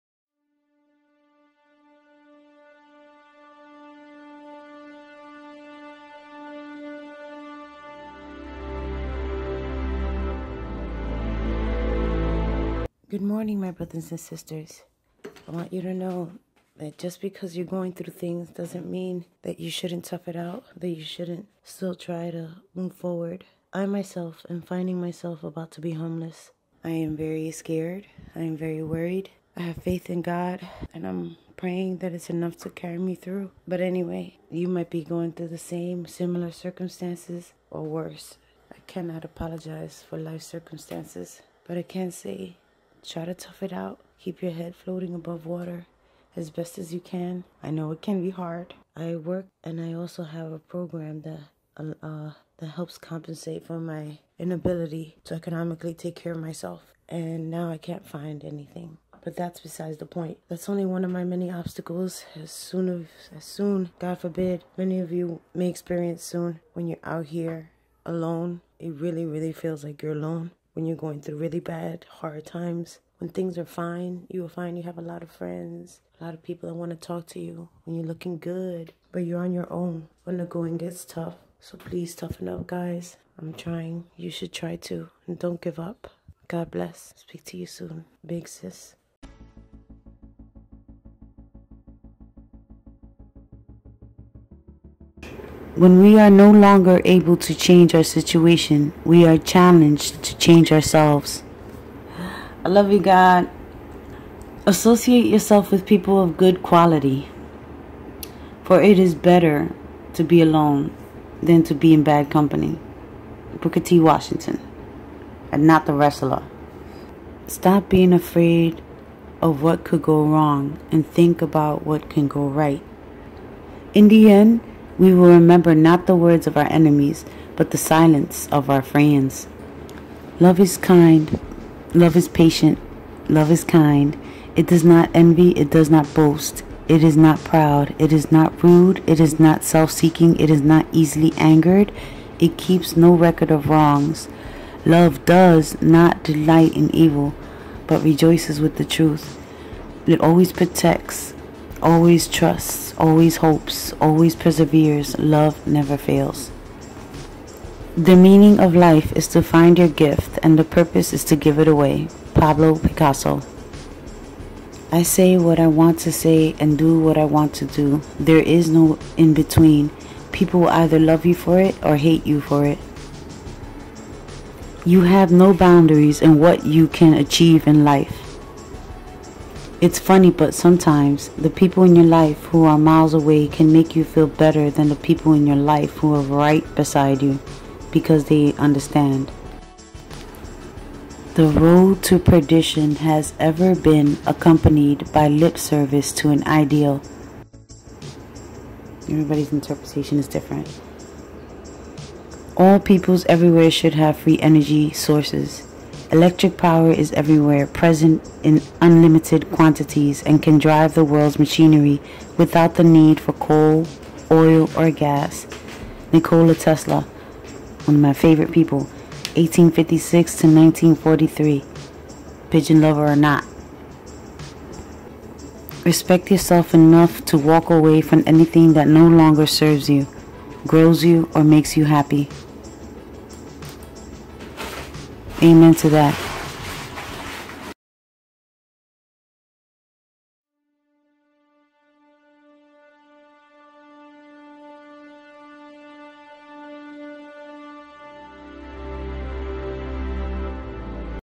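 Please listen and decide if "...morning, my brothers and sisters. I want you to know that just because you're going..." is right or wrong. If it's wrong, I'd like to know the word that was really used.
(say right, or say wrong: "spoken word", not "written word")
right.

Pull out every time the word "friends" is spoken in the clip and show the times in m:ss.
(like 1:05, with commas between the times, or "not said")
1:15, 2:08.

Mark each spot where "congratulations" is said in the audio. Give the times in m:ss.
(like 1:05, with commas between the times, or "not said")
not said.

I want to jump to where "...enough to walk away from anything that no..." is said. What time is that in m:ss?
3:46.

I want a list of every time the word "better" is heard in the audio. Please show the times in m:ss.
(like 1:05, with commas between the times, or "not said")
1:49, 3:04.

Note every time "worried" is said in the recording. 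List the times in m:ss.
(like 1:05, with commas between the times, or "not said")
0:28.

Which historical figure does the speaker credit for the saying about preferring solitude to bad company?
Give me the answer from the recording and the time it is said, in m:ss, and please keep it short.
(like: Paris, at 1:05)
Booker T. Washington, at 1:53.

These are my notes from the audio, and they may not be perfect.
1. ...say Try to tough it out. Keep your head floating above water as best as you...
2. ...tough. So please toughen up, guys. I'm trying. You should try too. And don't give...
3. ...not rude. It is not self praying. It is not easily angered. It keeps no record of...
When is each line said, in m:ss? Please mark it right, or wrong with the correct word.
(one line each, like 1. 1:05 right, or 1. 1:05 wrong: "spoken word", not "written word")
1. 0:42 right
2. 1:21 right
3. 2:18 wrong: "seeking", not "praying".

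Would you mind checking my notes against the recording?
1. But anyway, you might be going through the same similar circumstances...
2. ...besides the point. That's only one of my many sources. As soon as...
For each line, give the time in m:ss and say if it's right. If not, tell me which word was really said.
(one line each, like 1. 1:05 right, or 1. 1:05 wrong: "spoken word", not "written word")
1. 0:33 right
2. 0:59 wrong: "obstacles", not "sources".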